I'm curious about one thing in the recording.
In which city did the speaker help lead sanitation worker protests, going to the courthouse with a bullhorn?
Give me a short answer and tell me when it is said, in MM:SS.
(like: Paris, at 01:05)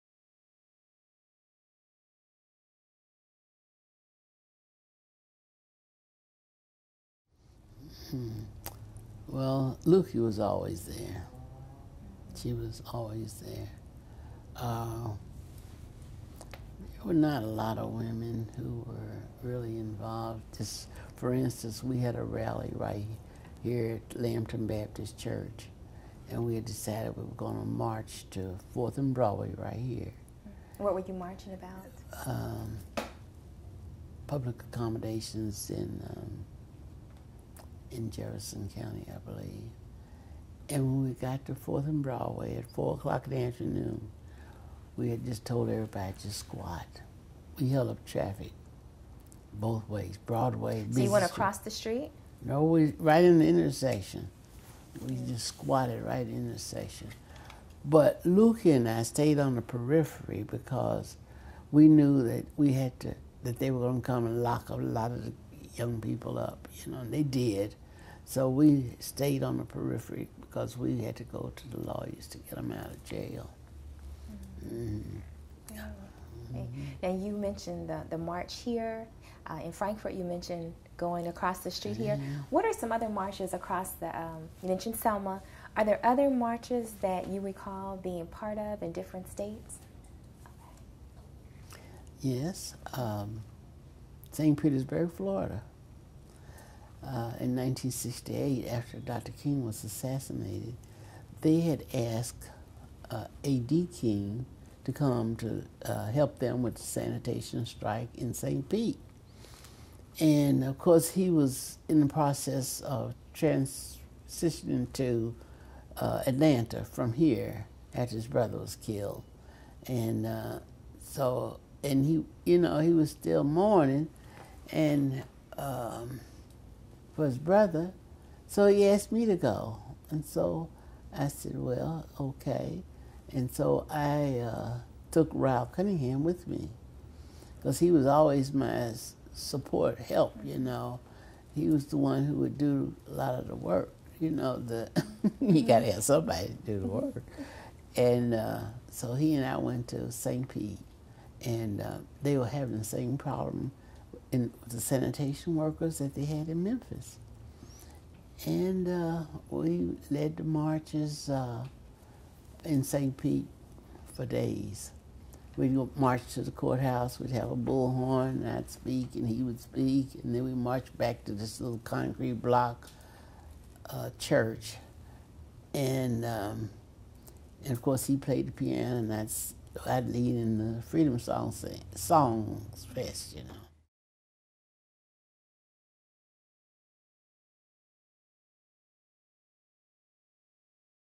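St. Petersburg, Florida, at 01:34.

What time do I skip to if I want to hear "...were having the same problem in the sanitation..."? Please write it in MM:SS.
02:32.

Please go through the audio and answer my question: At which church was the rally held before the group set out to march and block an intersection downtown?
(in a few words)
Lampton Baptist Church.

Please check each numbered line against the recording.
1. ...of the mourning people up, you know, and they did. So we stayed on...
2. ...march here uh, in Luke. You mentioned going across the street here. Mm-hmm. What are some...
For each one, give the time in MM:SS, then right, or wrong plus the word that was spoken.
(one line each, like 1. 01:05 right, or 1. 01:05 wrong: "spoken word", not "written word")
1. 01:05 wrong: "young", not "mourning"
2. 01:18 wrong: "Frankfort", not "Luke".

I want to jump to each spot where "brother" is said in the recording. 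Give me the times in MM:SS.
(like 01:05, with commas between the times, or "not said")
01:58, 02:07.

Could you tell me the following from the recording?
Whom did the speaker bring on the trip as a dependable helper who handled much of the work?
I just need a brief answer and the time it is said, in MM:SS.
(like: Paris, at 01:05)
Raoul Cunningham, at 02:15.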